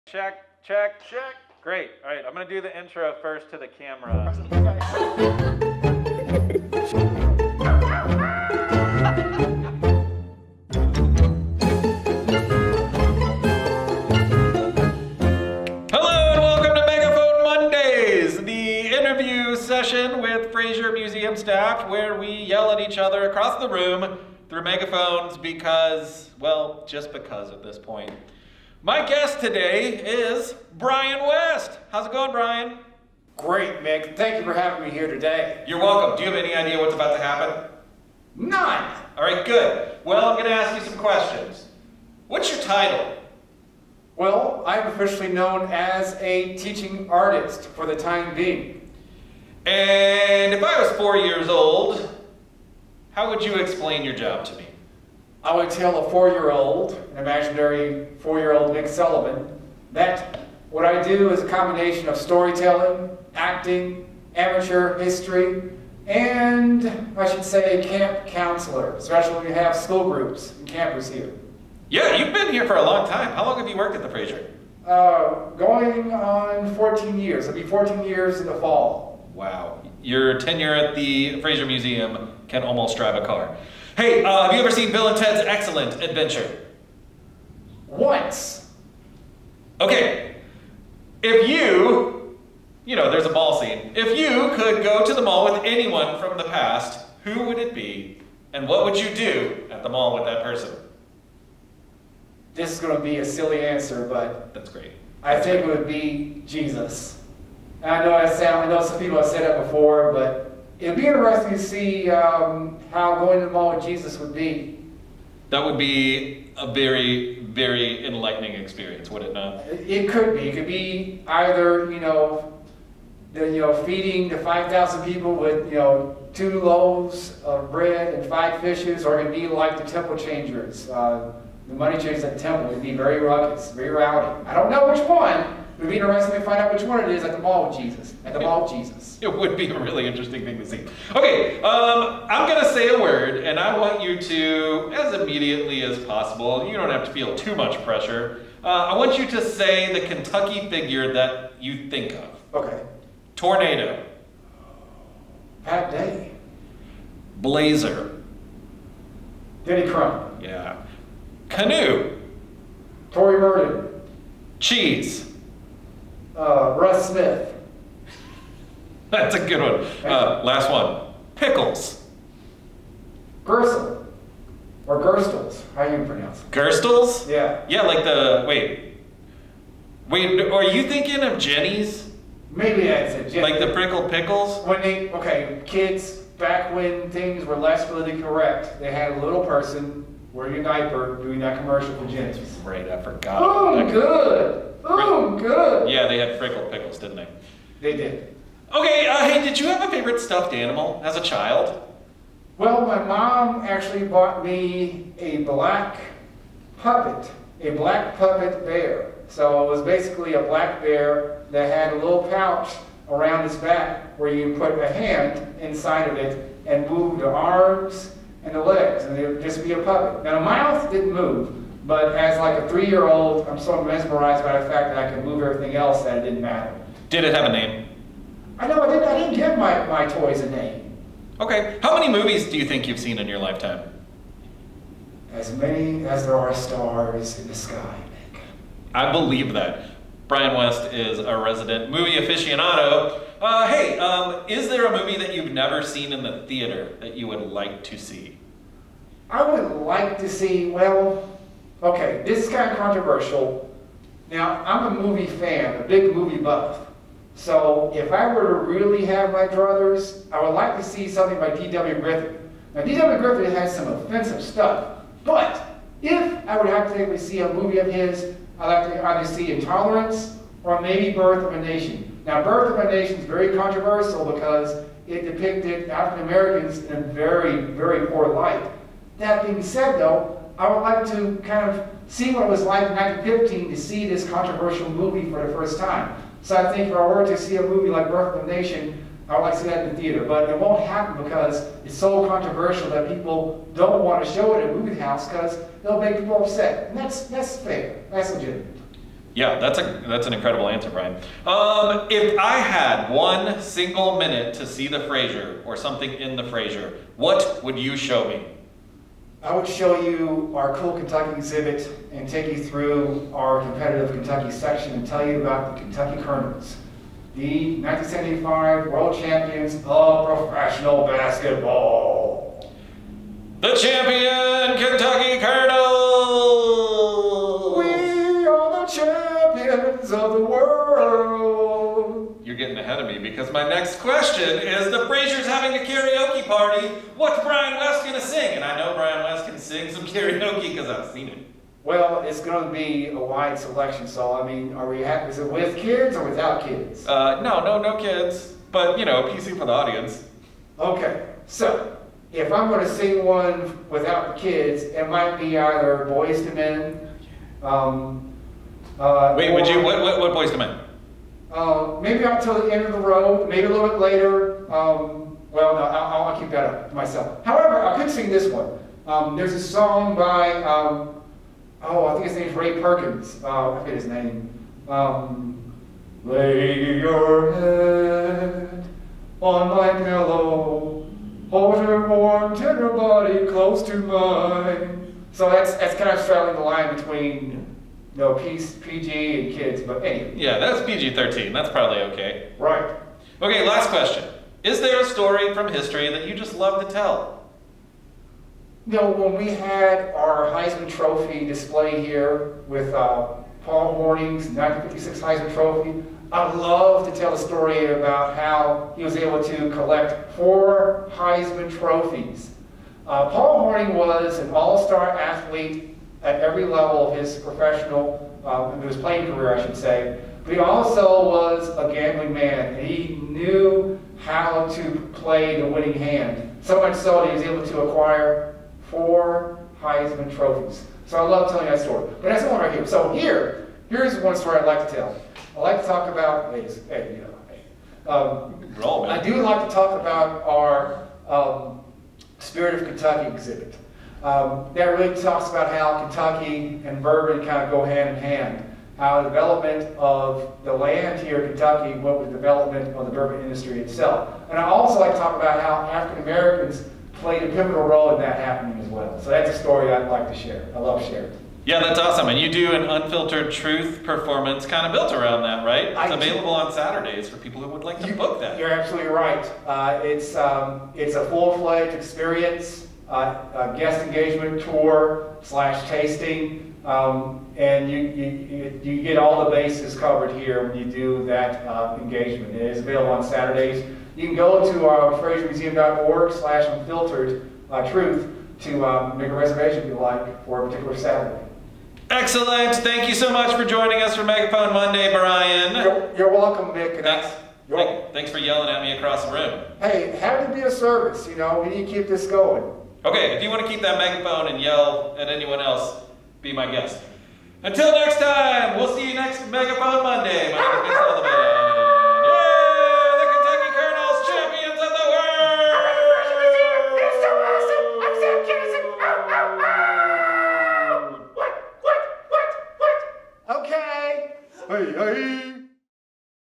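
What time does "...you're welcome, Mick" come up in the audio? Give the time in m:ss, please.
8:16.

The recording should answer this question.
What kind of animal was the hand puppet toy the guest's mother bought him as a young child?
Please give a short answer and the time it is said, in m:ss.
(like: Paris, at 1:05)
black bear, at 3:30.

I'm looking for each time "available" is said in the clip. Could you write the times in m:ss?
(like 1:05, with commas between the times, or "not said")
7:46, 8:02.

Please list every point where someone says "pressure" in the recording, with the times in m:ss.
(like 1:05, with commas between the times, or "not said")
2:27.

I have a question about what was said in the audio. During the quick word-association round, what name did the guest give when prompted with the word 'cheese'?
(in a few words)
Russ Smith.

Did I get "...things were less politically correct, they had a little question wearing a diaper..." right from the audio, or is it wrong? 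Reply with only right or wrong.
wrong.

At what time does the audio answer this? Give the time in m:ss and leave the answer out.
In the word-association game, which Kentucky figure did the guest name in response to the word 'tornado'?
2:35.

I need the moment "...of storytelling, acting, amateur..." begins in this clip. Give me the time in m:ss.
1:02.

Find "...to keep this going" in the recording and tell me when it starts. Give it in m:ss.
8:21.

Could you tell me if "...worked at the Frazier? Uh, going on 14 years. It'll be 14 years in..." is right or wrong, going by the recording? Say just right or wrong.
right.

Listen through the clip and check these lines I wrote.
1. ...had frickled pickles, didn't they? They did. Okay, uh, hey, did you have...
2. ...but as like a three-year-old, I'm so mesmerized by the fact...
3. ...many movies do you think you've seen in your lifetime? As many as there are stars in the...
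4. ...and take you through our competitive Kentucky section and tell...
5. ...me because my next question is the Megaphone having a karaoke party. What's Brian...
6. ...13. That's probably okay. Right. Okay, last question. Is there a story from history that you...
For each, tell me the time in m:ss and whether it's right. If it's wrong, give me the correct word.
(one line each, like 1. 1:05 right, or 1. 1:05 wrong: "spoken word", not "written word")
1. 3:16 right
2. 3:41 right
3. 3:51 right
4. 5:12 right
5. 5:33 wrong: "Fraziers", not "Megaphone"
6. 6:31 right.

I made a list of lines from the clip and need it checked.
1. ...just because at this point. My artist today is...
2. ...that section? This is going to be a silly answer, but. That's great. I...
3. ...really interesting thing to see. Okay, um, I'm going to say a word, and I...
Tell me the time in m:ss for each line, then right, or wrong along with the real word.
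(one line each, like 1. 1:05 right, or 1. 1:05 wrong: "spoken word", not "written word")
1. 0:26 wrong: "guest", not "artist"
2. 1:40 wrong: "person", not "section"
3. 2:19 right.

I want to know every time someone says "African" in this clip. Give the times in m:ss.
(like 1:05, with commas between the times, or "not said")
4:35, 7:35.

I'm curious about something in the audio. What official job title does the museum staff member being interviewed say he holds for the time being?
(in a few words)
teaching artist.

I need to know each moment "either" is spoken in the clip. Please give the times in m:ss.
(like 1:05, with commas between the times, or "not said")
2:01, 4:29, 5:55.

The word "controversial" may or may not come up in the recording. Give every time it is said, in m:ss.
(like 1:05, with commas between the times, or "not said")
4:12, 4:33, 4:44, 4:52.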